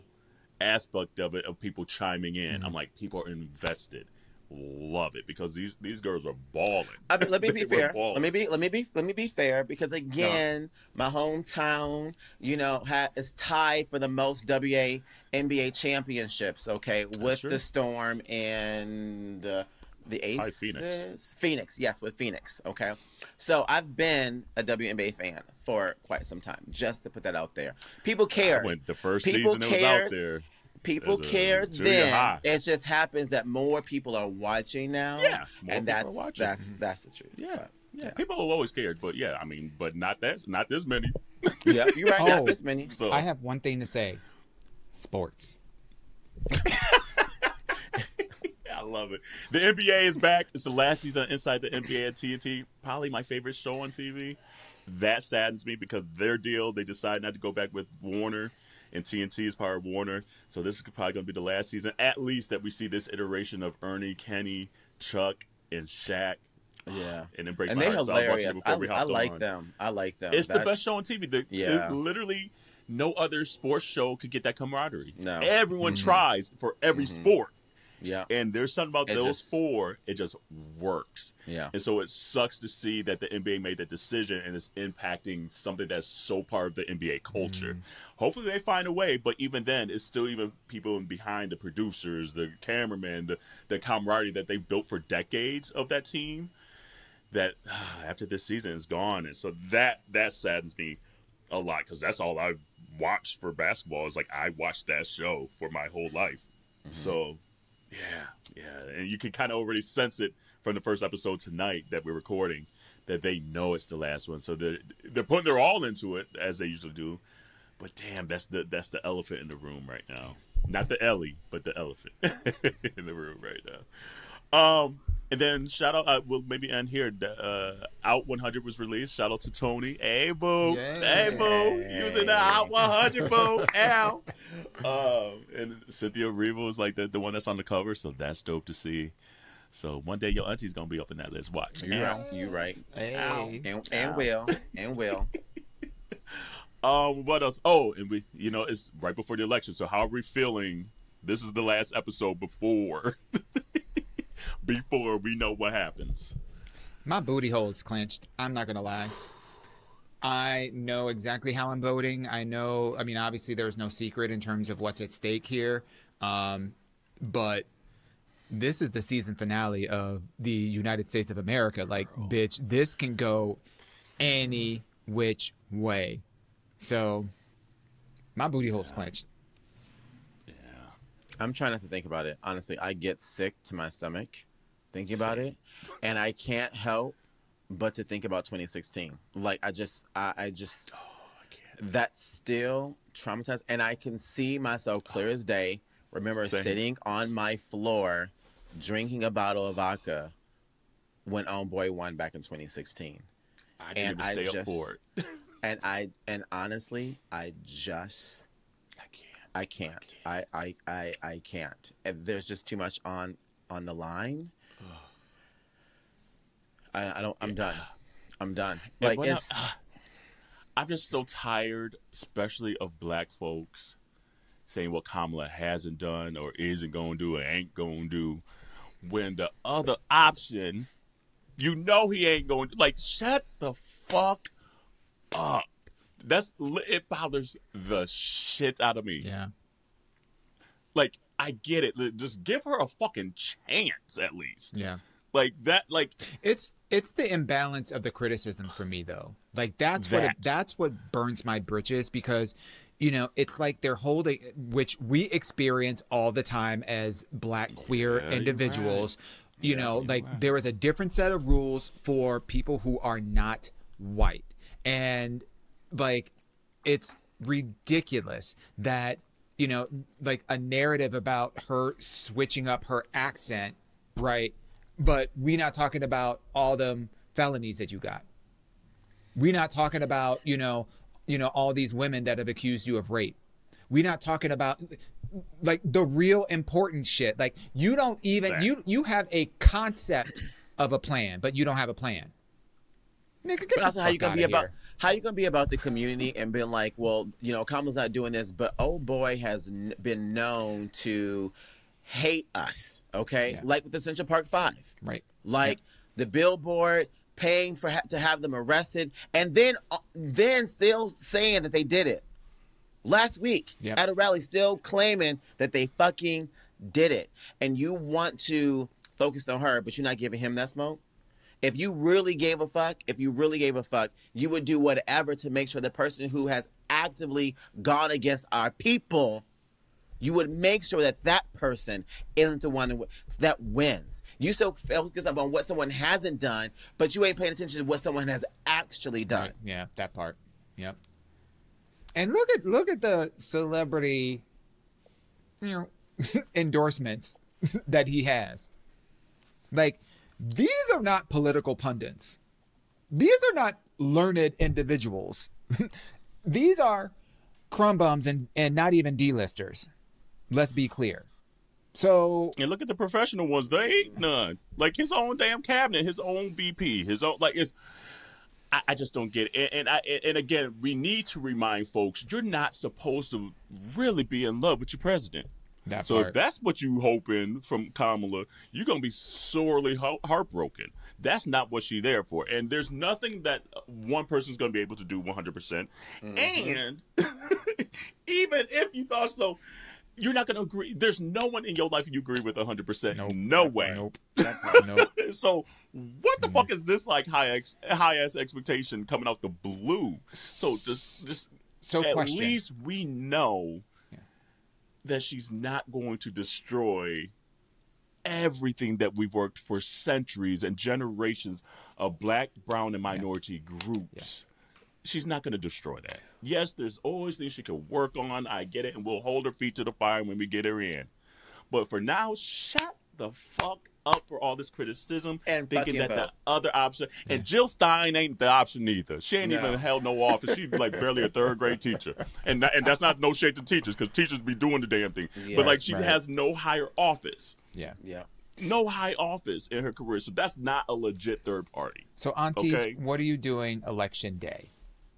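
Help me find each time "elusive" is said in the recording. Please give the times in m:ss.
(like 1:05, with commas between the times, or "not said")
not said.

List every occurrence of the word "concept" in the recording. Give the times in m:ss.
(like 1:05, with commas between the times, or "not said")
4:49.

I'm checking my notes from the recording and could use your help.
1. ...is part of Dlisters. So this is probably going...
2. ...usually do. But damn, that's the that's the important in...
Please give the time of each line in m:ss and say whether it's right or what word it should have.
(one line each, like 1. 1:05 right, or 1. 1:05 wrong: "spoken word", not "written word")
1. 0:59 wrong: "Warner", not "Dlisters"
2. 1:56 wrong: "elephant", not "important".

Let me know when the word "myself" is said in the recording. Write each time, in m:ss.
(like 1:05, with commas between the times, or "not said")
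3:14.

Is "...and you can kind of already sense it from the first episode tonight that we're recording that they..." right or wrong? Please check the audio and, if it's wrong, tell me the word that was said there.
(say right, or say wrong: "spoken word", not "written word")
right.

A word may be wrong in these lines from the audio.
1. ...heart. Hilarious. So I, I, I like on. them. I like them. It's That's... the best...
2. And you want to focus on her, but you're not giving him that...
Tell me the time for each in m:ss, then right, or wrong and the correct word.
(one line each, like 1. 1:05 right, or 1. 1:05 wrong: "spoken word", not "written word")
1. 1:07 right
2. 5:17 right.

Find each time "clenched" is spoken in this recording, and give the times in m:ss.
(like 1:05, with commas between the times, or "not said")
2:37, 2:58.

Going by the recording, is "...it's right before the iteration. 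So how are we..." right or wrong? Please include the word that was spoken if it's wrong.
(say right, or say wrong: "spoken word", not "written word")
wrong: "election", not "iteration".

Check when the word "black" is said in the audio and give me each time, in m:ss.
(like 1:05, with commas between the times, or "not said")
3:42, 4:17, 6:52.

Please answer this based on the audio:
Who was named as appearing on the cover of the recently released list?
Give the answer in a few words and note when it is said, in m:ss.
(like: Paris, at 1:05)
Cynthia Erivo, at 2:15.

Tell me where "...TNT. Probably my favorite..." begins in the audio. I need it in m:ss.
0:52.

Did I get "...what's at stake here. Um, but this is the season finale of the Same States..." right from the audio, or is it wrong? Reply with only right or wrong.
wrong.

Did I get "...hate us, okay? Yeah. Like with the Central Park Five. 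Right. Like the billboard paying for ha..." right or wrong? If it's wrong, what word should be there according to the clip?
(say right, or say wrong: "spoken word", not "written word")
right.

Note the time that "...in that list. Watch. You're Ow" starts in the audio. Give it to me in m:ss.
2:21.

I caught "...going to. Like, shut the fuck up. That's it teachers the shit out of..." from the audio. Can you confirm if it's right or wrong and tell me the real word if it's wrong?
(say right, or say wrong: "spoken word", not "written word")
wrong: "bothers", not "teachers".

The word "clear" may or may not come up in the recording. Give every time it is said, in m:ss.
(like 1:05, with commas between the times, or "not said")
3:15, 6:00.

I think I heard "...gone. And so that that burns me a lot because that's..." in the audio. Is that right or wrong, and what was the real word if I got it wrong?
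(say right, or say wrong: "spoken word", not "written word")
wrong: "saddens", not "burns".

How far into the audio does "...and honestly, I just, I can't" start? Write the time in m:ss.
3:26.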